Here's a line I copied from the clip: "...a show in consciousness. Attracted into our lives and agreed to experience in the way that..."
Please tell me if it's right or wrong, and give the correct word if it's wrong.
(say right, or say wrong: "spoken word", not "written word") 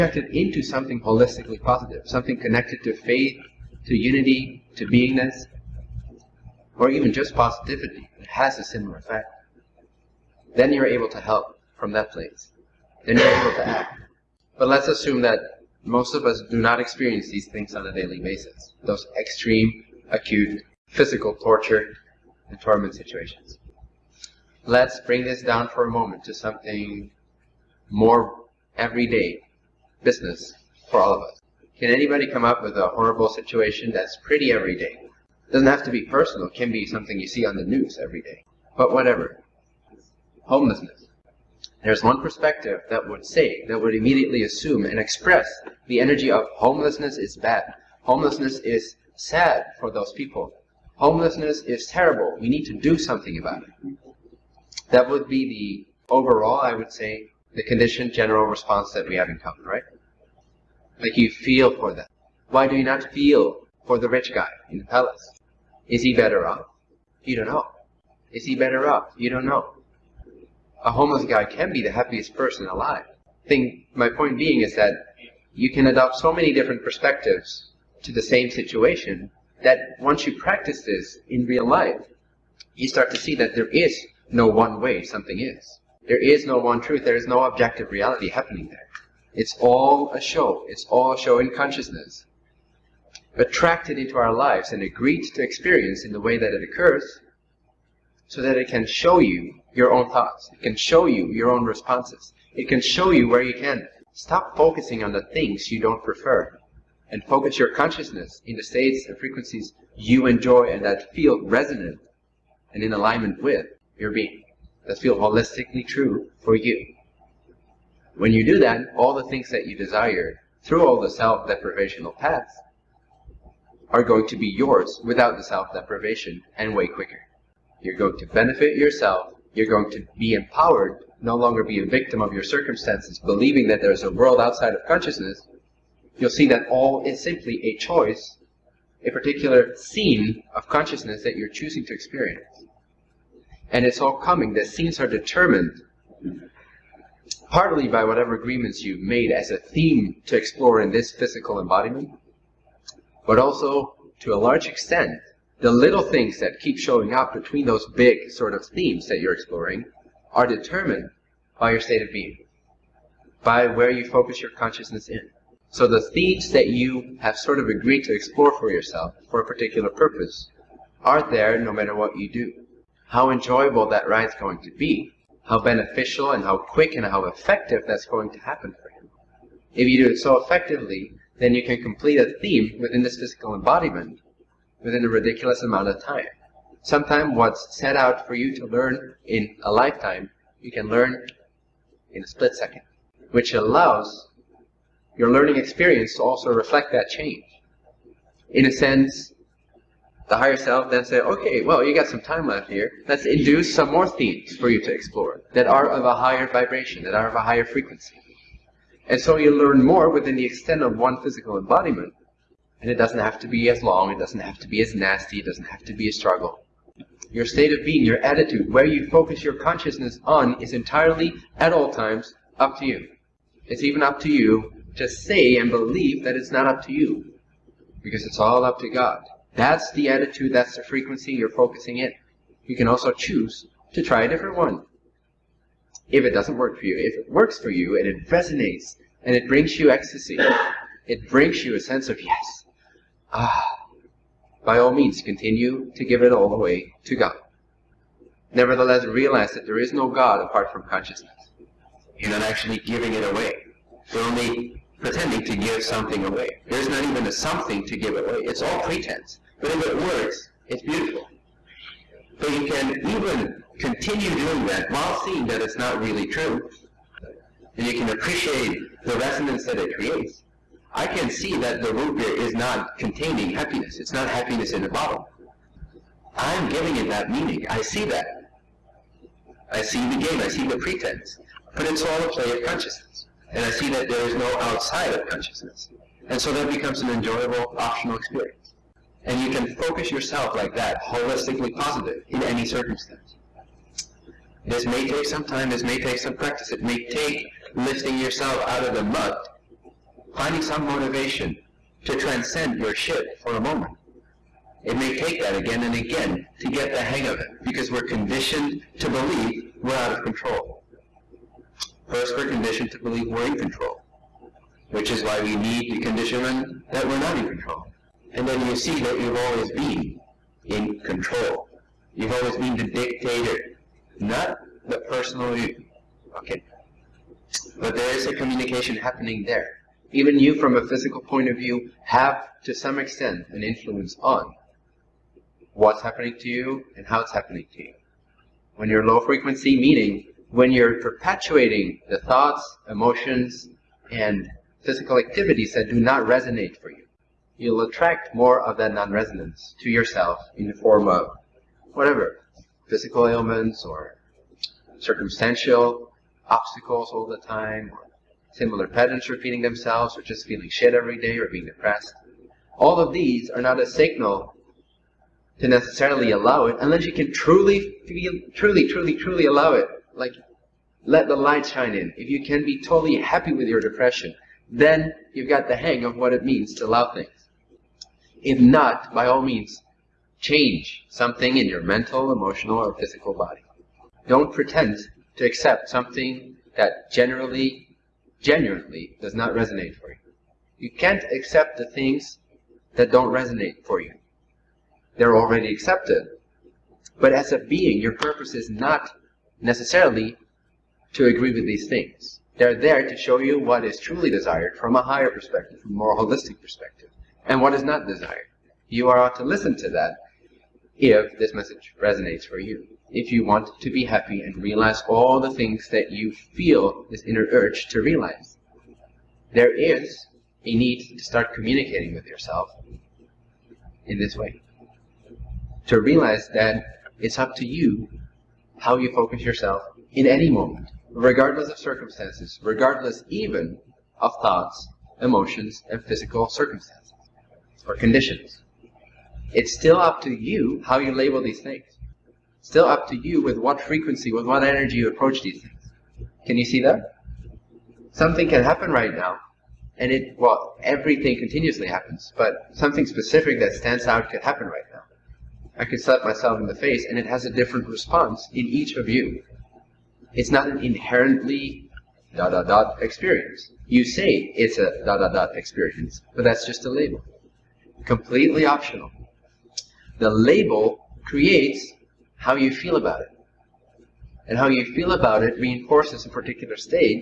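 right.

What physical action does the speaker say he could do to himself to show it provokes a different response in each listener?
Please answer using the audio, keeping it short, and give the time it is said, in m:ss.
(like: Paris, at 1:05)
Slap myself in the face, at 7:35.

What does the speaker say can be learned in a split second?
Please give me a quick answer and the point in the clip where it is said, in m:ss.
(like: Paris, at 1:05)
what's set out for you to learn in a lifetime, at 3:07.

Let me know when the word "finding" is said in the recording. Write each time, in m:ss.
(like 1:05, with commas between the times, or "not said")
5:00.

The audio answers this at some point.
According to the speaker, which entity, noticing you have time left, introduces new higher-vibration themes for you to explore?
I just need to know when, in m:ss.
3:20.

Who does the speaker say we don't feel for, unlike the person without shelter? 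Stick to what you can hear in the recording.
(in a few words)
the rich guy in the palace.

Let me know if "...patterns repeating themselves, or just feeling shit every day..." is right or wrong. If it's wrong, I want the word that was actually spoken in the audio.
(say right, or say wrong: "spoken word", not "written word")
right.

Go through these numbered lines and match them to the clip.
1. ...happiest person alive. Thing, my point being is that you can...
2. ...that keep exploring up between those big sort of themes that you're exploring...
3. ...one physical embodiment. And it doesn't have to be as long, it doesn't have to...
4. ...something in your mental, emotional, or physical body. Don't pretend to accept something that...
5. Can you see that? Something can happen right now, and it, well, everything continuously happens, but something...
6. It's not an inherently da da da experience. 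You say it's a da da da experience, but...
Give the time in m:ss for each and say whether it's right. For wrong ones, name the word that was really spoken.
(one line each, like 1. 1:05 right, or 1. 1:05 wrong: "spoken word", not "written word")
1. 1:11 right
2. 2:36 wrong: "showing", not "exploring"
3. 3:30 right
4. 6:21 right
5. 7:26 right
6. 7:40 right.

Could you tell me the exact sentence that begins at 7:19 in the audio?
It's still up to you how you label these things.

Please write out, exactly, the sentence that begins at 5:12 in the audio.
First, we're conditioned to believe we're in control, which is why we need the conditionment that we're not in control.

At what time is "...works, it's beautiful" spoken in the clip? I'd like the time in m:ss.
4:19.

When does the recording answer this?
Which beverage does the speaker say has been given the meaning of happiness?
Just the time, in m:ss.
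4:31.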